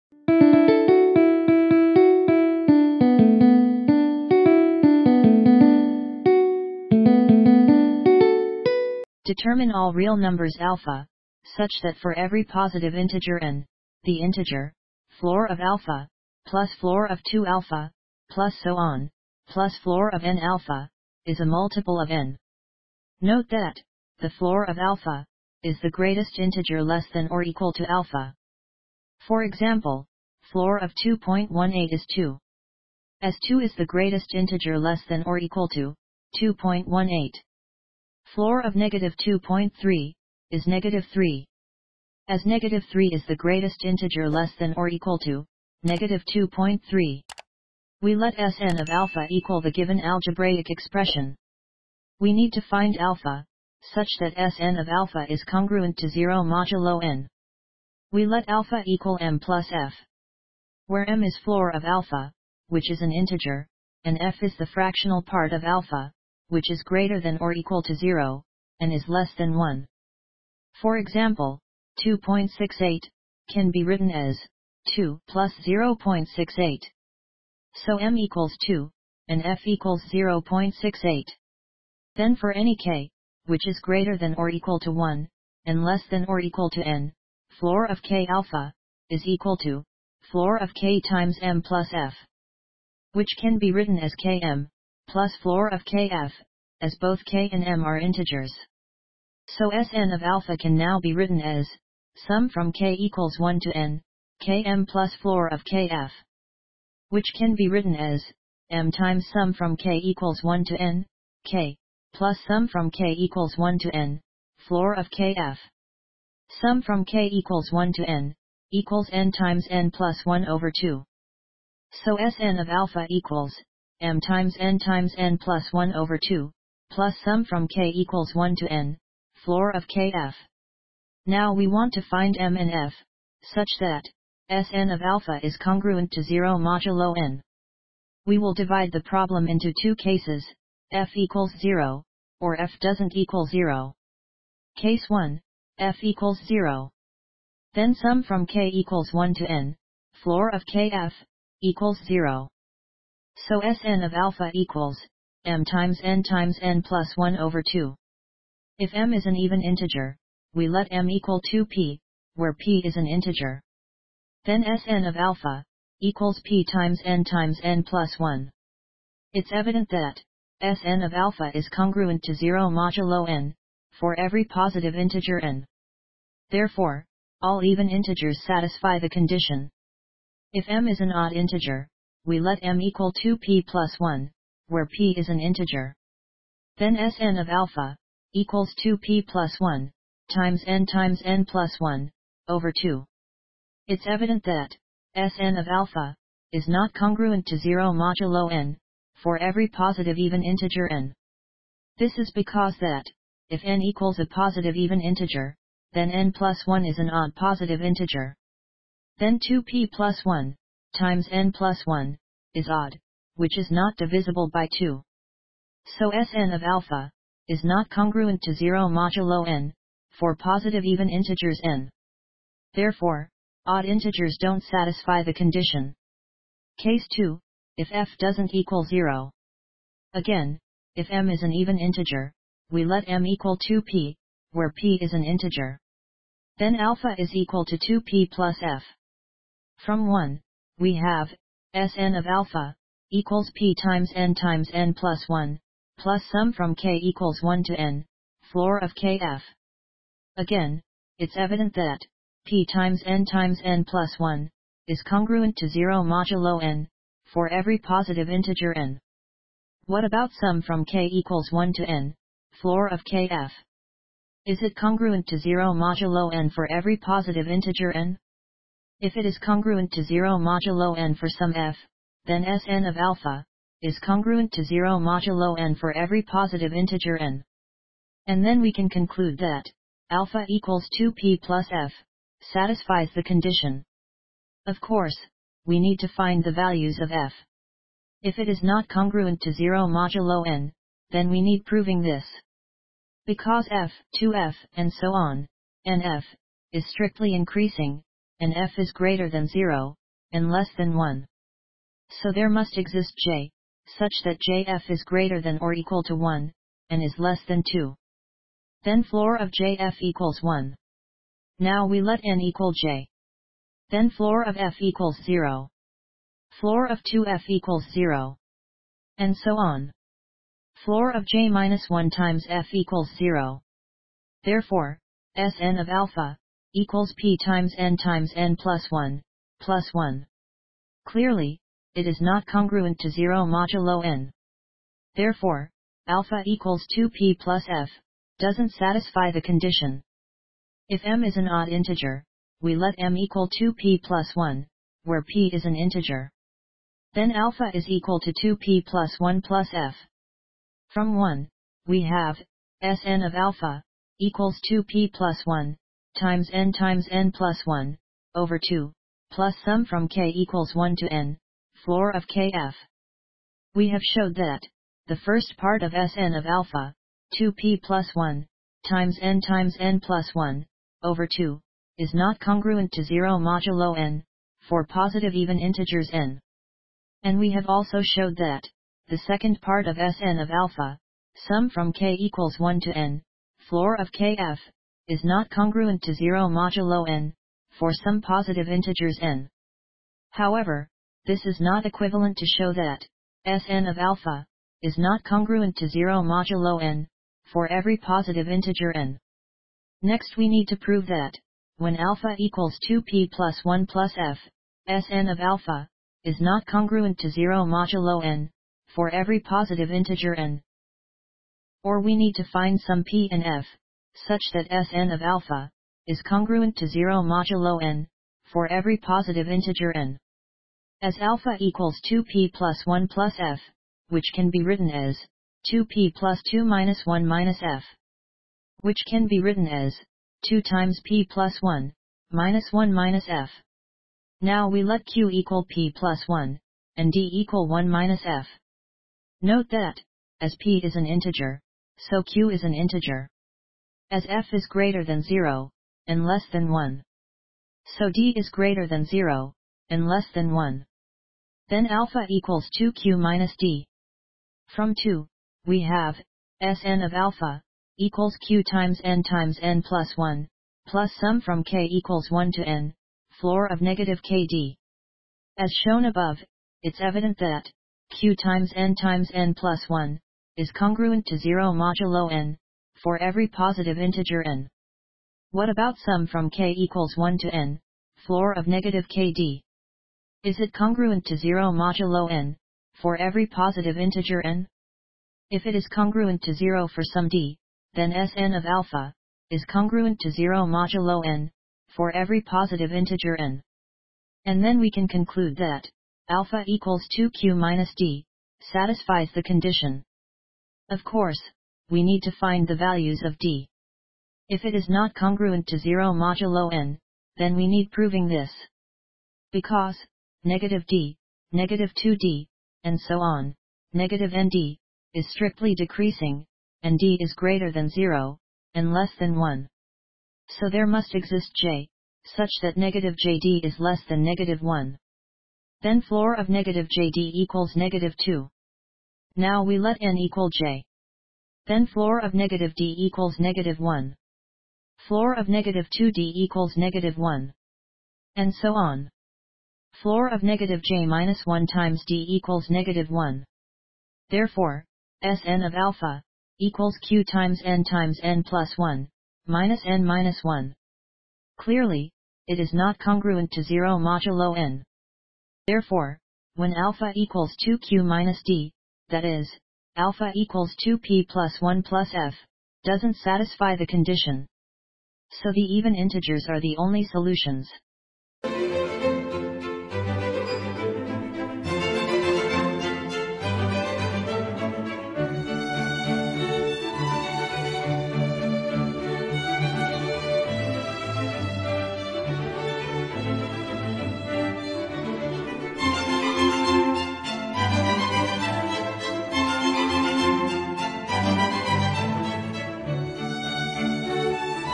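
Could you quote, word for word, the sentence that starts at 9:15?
Therefore, when alpha equals 2q minus d, that is, alpha equals 2p plus 1 plus f, doesn't satisfy the condition.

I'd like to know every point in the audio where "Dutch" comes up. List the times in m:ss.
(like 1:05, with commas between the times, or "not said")
not said.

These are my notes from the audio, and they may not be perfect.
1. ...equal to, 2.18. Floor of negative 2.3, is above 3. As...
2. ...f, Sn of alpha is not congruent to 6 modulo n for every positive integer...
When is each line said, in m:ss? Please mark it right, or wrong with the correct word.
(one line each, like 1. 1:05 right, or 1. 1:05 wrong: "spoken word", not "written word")
1. 0:35 wrong: "negative", not "above"
2. 6:44 wrong: "0", not "6".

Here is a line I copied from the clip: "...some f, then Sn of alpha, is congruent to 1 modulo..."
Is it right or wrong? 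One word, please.
wrong.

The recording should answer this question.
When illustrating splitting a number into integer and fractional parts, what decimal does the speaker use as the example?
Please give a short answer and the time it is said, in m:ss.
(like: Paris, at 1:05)
2.68, at 1:12.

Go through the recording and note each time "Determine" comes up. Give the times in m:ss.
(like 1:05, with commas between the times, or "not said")
0:09.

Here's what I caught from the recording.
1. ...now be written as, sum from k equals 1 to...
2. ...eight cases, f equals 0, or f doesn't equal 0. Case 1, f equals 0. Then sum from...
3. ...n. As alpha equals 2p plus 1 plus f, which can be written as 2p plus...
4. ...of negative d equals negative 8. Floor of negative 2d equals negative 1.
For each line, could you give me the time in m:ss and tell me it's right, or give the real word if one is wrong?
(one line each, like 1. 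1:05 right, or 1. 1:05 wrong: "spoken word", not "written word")
1. 1:40 right
2. 2:19 wrong: "two", not "eight"
3. 6:59 right
4. 8:52 wrong: "1", not "8".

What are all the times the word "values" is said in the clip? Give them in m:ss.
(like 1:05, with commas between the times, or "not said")
4:46, 8:22.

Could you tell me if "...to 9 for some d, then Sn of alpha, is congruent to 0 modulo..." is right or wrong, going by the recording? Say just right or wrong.
wrong.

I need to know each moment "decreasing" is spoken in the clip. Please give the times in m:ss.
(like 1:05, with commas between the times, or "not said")
8:35.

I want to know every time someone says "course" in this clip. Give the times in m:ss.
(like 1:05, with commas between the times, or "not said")
4:44, 8:21.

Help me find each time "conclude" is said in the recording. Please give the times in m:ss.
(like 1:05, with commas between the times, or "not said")
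4:38, 8:15.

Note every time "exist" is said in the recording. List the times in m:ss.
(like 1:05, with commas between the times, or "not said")
5:02, 8:41.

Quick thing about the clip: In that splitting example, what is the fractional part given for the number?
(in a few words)
0.68.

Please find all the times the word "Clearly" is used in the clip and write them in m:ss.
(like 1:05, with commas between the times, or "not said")
5:31, 9:11.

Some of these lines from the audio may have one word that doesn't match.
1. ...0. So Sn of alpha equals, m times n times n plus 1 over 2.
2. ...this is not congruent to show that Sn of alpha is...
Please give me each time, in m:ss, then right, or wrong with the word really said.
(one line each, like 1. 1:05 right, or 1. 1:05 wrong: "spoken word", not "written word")
1. 2:32 right
2. 6:31 wrong: "equivalent", not "congruent".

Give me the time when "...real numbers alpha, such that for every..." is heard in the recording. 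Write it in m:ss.
0:09.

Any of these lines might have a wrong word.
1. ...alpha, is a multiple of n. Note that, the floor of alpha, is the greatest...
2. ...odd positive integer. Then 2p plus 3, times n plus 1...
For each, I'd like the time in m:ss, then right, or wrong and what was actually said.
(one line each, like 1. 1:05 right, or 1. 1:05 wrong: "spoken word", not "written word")
1. 0:20 right
2. 3:27 wrong: "1", not "3".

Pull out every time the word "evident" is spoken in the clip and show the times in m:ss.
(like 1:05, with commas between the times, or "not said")
2:49, 3:14, 4:11, 7:46.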